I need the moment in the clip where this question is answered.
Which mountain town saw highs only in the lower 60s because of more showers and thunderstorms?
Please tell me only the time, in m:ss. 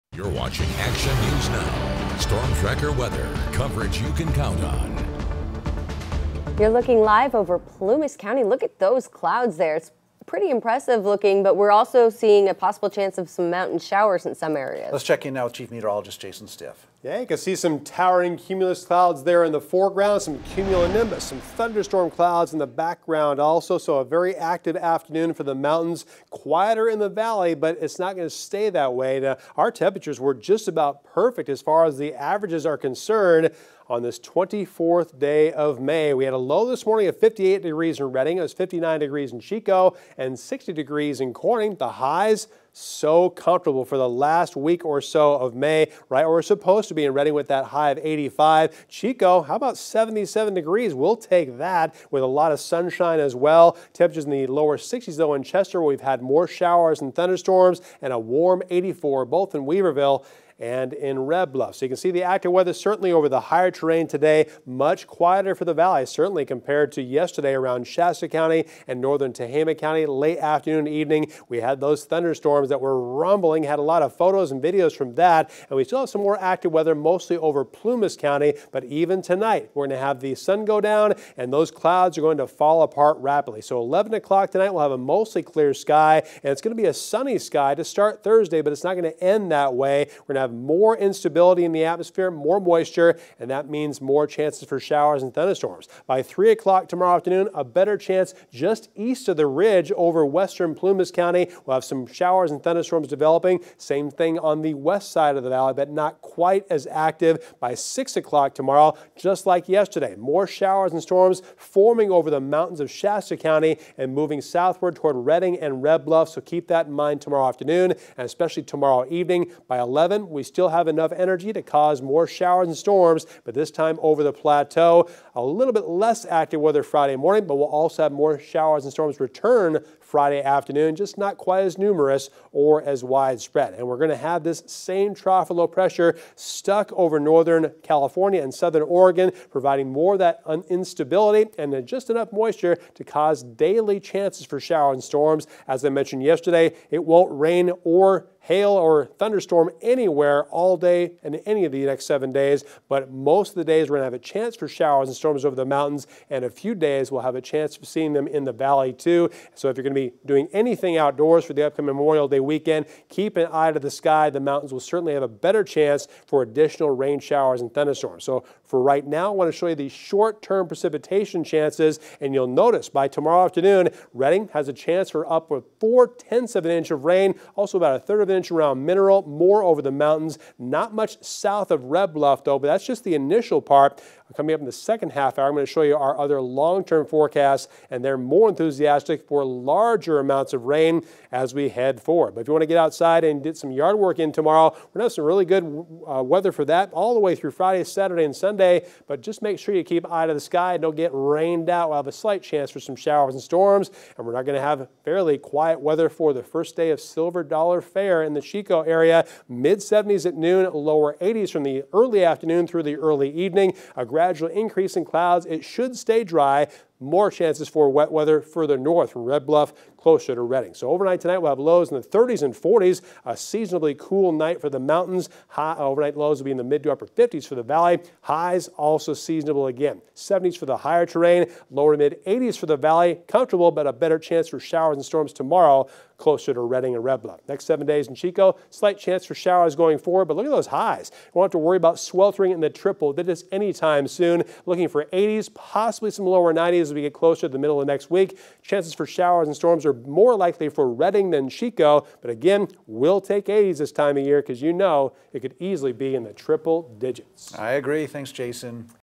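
0:55.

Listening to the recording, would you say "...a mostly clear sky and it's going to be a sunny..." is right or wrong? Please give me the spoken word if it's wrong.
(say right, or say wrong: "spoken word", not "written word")
right.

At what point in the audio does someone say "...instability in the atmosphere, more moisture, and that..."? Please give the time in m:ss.
1:30.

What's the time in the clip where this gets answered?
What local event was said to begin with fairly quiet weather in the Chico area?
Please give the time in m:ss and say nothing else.
3:27.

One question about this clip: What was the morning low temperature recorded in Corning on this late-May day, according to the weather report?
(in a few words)
60 degrees.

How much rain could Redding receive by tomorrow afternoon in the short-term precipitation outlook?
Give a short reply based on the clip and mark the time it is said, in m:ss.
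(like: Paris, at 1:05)
0.4 inch, at 2:55.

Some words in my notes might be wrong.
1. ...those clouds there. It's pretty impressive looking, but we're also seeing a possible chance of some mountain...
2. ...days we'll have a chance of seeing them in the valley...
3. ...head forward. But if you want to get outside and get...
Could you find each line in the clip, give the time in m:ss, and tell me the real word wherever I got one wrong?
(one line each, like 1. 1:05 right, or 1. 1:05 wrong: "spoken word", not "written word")
1. 0:08 right
2. 2:36 right
3. 3:11 right.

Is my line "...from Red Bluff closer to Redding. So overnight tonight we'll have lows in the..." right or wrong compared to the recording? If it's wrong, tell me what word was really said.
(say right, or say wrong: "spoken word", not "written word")
right.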